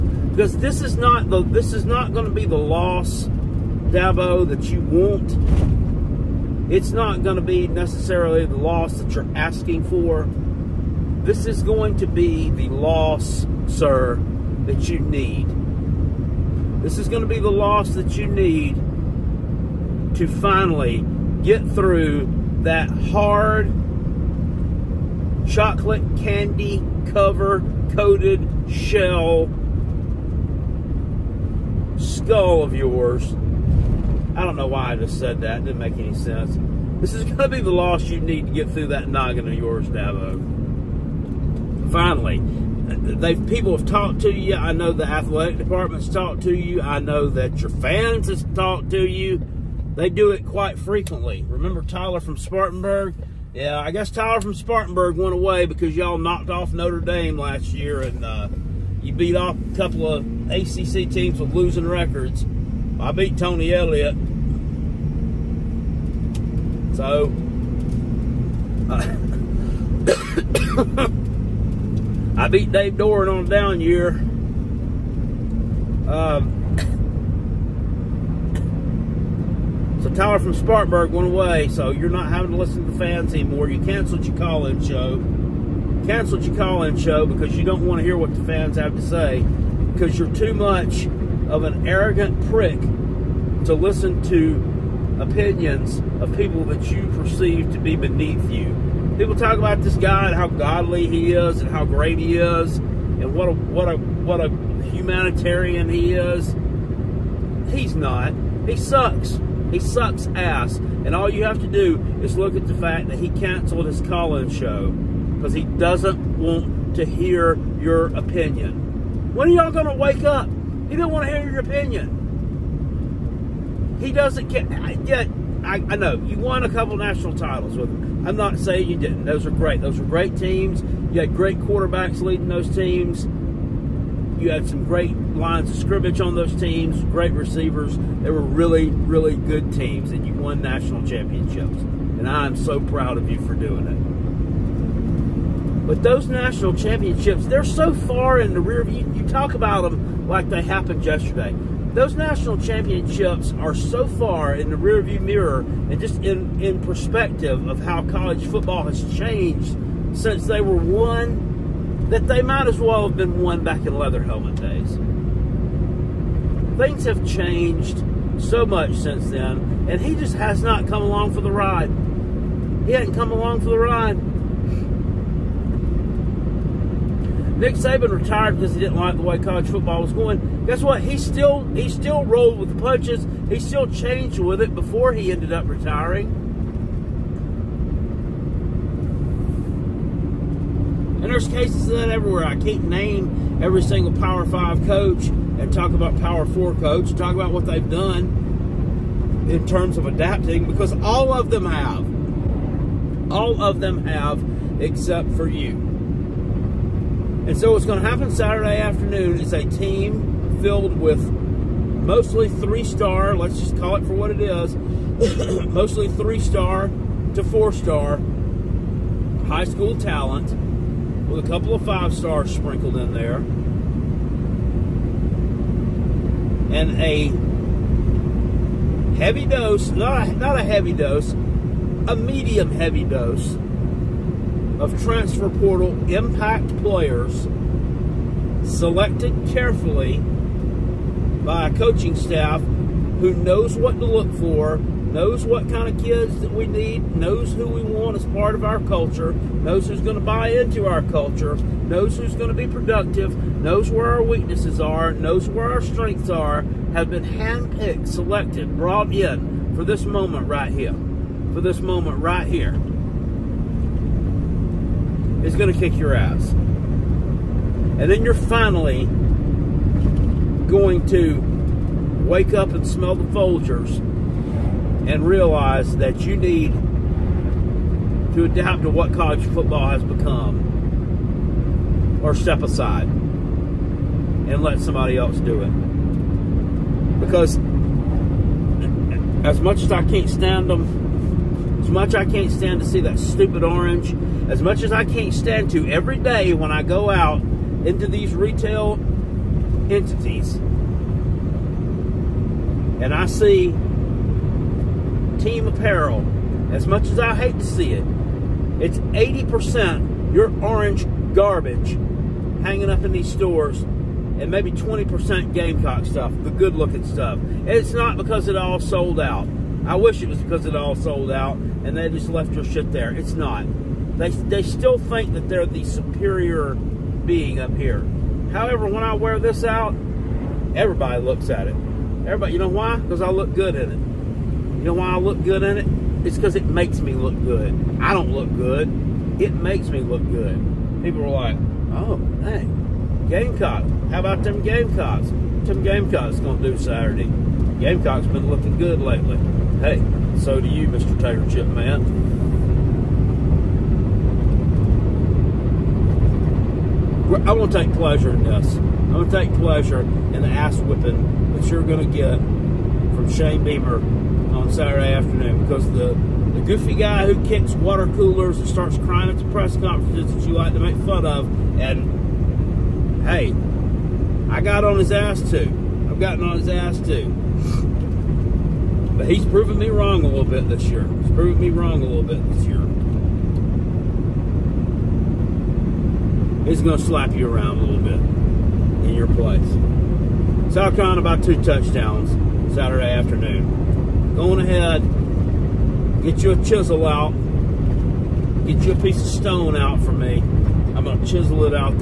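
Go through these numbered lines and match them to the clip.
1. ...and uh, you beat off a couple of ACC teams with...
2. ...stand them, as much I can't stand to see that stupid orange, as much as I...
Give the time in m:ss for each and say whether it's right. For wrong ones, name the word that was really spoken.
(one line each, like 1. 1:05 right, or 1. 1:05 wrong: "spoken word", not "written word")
1. 0:58 right
2. 4:50 right.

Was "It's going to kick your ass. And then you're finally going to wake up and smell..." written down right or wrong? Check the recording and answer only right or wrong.
right.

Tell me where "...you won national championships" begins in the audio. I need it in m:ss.
2:20.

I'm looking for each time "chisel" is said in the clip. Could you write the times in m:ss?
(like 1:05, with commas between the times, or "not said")
6:36, 6:41.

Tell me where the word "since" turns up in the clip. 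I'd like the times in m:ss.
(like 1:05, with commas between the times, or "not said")
2:40, 2:48.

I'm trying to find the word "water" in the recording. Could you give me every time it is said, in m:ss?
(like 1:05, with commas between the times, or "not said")
6:07.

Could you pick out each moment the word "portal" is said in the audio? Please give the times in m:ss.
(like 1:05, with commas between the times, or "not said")
3:55.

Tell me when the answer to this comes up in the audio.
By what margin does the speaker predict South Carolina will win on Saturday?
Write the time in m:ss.
6:31.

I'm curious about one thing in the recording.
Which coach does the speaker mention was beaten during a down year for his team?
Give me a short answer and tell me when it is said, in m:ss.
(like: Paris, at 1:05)
Dave Doeren, at 1:12.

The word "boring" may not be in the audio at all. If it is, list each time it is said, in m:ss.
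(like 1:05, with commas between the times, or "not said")
not said.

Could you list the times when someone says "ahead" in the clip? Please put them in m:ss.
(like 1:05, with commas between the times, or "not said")
6:34.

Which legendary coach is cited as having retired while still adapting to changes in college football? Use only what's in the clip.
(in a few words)
Nick Saban.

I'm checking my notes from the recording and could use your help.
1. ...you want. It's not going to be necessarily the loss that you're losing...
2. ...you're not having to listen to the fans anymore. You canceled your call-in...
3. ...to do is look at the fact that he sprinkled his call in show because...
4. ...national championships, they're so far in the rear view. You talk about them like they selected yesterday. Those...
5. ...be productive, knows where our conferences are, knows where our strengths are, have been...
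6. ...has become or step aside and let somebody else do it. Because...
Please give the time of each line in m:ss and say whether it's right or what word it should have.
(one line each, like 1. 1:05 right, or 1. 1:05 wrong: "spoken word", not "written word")
1. 0:04 wrong: "asking", not "losing"
2. 1:21 right
3. 1:51 wrong: "canceled", not "sprinkled"
4. 2:26 wrong: "happened", not "selected"
5. 4:12 wrong: "weaknesses", not "conferences"
6. 4:39 right.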